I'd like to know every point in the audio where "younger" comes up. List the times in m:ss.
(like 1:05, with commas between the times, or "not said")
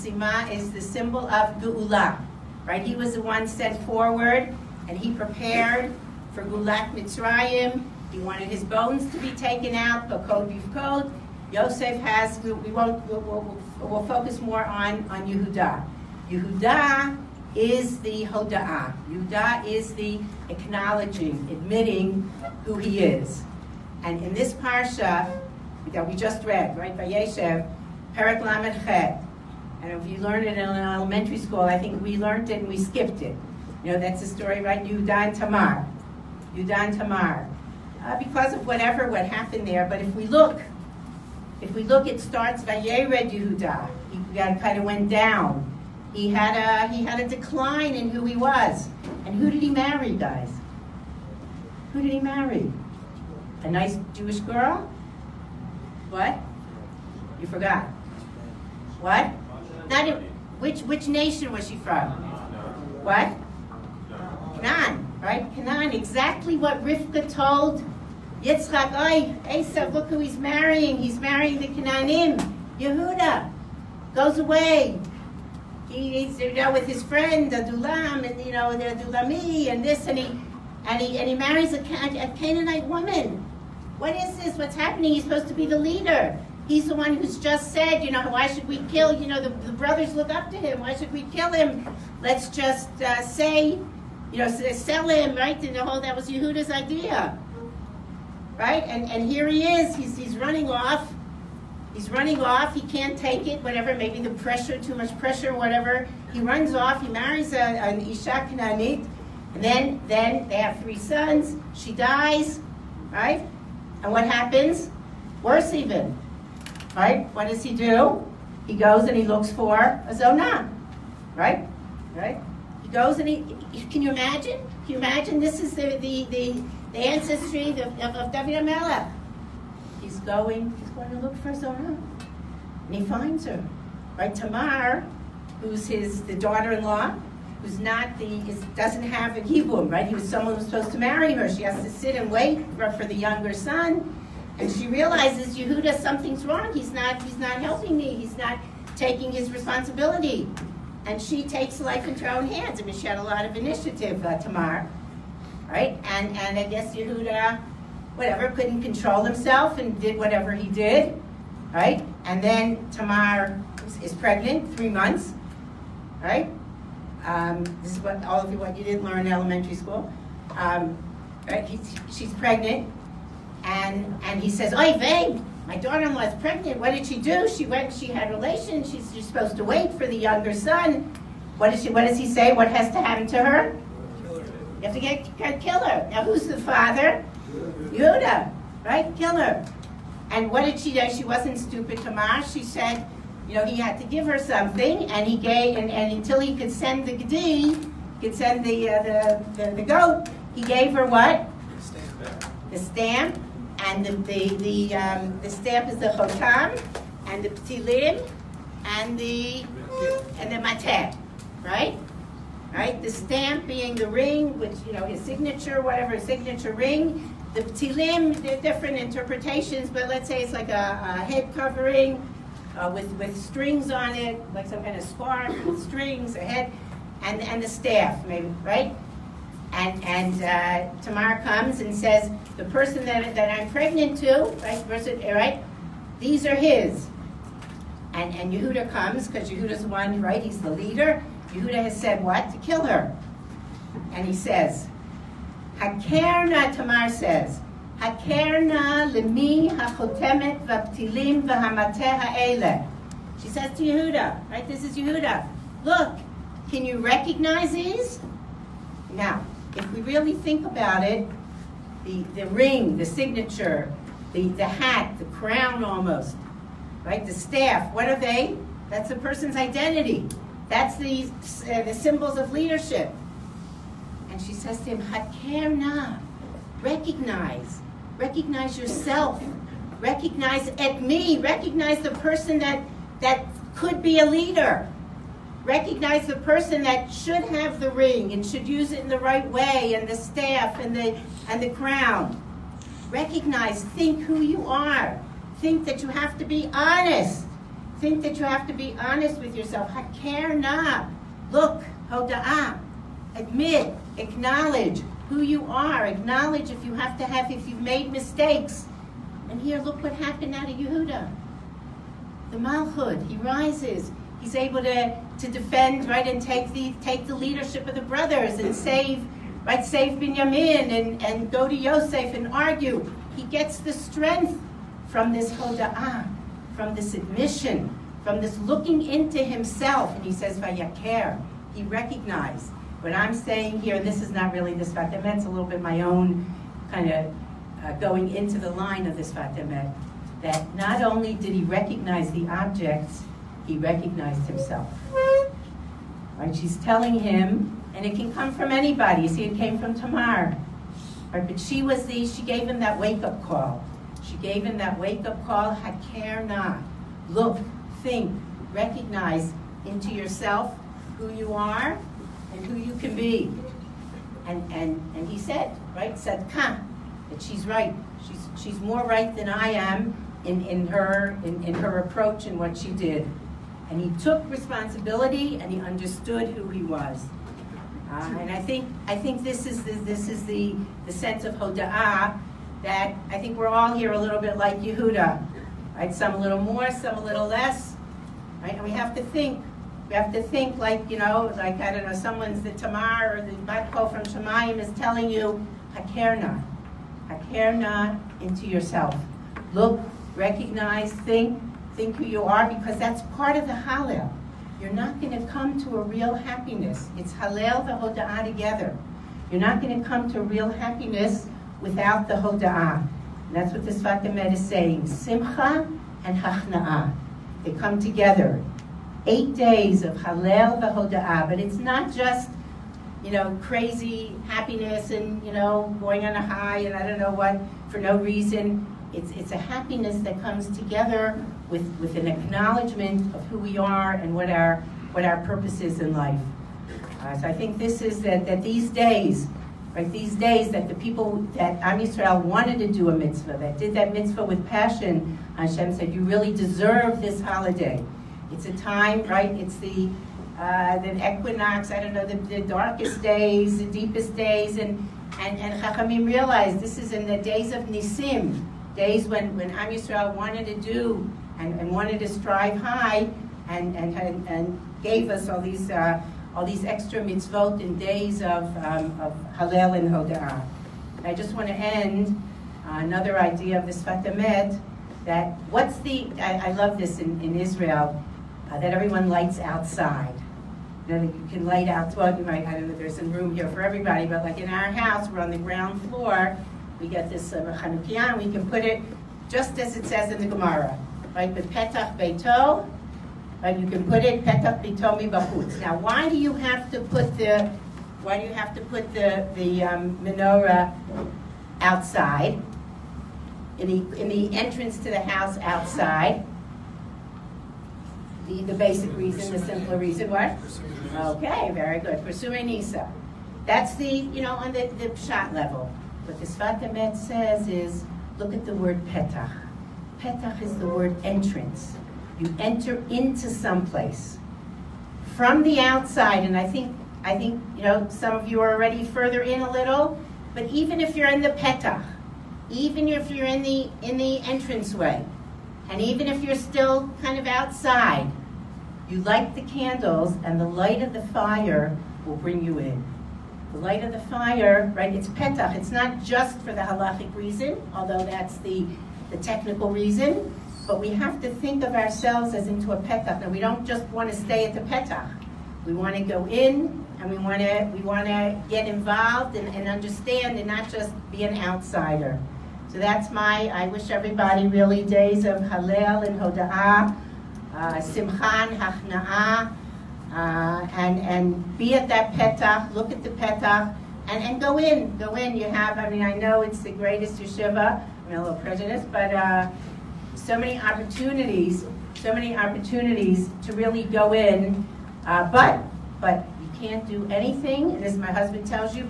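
2:23, 3:00.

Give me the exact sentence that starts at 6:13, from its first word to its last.
And he took responsibility and he understood who he was.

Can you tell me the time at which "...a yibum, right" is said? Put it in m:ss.
2:19.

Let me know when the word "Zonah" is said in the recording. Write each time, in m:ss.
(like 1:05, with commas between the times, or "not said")
2:00.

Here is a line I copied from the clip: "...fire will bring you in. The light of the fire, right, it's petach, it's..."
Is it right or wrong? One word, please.
right.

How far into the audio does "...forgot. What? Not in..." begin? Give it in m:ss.
0:57.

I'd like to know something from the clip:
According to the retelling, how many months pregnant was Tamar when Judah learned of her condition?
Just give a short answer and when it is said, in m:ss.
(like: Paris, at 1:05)
3, at 2:44.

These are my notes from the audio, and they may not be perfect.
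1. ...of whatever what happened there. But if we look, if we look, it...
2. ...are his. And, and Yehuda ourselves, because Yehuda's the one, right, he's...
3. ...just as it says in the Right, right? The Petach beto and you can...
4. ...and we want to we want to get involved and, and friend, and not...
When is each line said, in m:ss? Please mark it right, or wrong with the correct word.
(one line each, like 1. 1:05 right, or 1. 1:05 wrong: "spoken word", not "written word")
1. 0:38 right
2. 3:56 wrong: "comes", not "ourselves"
3. 8:09 wrong: "Gemara", not "Right"
4. 9:17 wrong: "understand", not "friend".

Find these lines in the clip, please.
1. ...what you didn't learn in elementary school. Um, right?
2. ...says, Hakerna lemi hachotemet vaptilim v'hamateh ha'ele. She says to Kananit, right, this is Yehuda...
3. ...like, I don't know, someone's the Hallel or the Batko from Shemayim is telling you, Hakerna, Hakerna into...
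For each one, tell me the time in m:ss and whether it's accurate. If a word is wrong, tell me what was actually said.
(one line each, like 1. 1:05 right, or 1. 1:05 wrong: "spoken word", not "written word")
1. 2:48 right
2. 4:07 wrong: "Yehuda", not "Kananit"
3. 6:31 wrong: "Tamar", not "Hallel".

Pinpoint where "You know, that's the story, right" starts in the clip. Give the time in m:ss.
0:33.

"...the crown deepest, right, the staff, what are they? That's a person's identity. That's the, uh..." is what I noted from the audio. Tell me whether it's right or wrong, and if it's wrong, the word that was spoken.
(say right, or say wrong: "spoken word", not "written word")
wrong: "almost", not "deepest".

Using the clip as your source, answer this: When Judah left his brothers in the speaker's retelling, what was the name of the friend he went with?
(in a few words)
Adulam.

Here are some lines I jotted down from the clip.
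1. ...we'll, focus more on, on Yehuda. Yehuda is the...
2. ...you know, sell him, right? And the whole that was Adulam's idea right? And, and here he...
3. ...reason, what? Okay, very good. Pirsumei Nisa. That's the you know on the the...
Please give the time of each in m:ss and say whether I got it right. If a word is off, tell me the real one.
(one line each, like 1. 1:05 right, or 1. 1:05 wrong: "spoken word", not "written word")
1. 0:13 right
2. 1:34 wrong: "Yehuda", not "Adulam"
3. 8:29 right.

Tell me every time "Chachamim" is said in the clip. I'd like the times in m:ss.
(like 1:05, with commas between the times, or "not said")
7:35.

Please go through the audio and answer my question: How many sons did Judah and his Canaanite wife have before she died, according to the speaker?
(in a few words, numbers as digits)
3.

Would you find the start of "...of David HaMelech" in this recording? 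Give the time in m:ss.
2:08.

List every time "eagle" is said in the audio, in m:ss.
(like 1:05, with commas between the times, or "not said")
not said.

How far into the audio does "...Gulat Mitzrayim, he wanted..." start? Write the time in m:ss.
0:06.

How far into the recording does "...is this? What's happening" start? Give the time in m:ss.
1:24.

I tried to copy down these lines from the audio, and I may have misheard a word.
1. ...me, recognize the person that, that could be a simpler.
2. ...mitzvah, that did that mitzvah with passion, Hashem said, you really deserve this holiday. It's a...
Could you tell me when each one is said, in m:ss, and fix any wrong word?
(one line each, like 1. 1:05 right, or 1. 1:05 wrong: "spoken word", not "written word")
1. 4:41 wrong: "leader", not "simpler"
2. 7:23 right.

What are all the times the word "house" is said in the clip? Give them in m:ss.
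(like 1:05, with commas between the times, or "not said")
8:04, 8:25.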